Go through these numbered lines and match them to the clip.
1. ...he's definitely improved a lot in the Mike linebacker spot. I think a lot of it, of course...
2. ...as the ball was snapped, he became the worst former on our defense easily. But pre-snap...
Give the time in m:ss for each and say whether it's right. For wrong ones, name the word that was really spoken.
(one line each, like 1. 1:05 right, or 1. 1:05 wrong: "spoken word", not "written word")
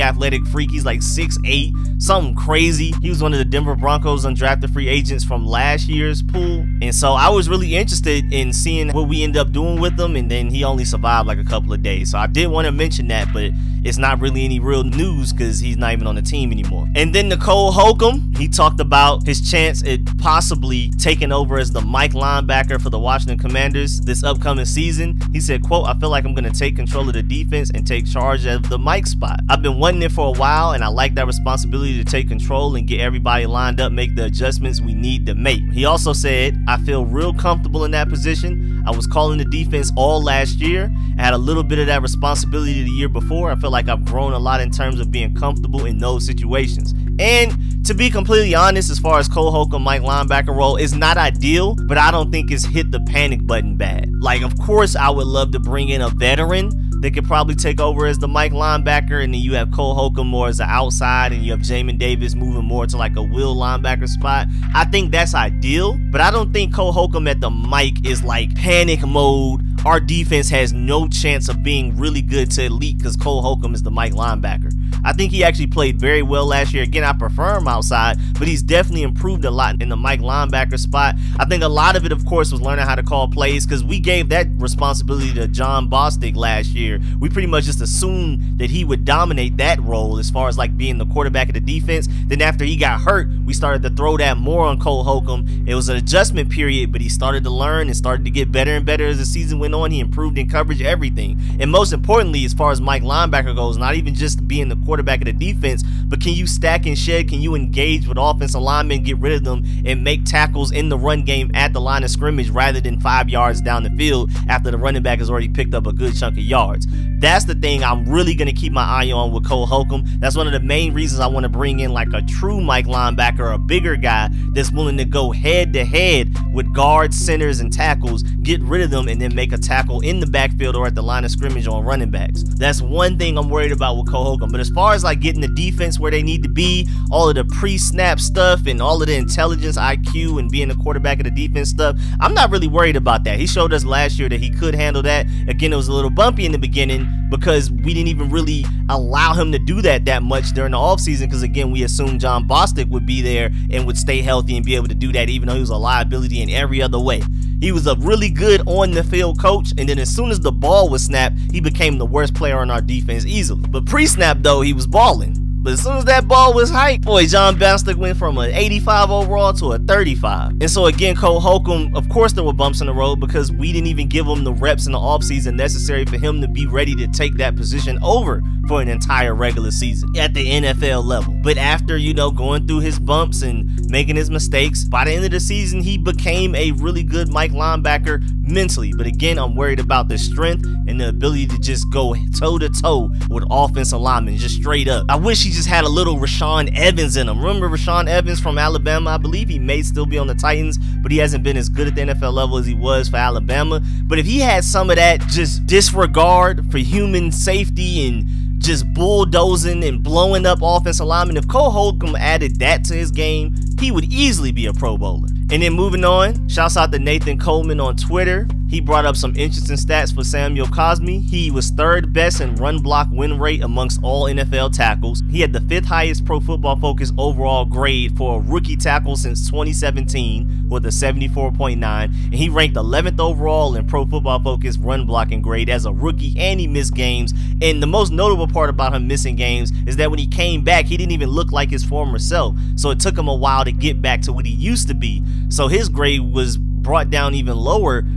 1. 1:18 right
2. 2:40 wrong: "player", not "former".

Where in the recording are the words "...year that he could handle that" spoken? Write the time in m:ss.
2:24.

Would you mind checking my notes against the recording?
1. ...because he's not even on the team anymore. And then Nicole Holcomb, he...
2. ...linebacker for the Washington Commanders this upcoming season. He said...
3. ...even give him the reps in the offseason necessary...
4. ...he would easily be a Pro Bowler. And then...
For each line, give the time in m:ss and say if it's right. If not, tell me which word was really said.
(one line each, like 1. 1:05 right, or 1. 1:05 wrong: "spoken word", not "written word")
1. 0:15 right
2. 0:22 right
3. 2:53 right
4. 3:33 right.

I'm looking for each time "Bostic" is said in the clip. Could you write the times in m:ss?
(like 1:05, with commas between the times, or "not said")
1:25, 2:32, 2:47.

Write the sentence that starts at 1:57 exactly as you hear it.
That's the thing I'm really going to keep my eye on with Cole Holcomb.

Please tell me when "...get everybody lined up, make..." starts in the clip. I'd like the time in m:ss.
0:32.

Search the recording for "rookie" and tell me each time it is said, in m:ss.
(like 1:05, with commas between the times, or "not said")
3:48, 3:55.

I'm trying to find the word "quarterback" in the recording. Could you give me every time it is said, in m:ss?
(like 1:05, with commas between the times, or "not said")
1:31, 1:44, 2:20.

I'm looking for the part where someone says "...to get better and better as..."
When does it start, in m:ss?
1:38.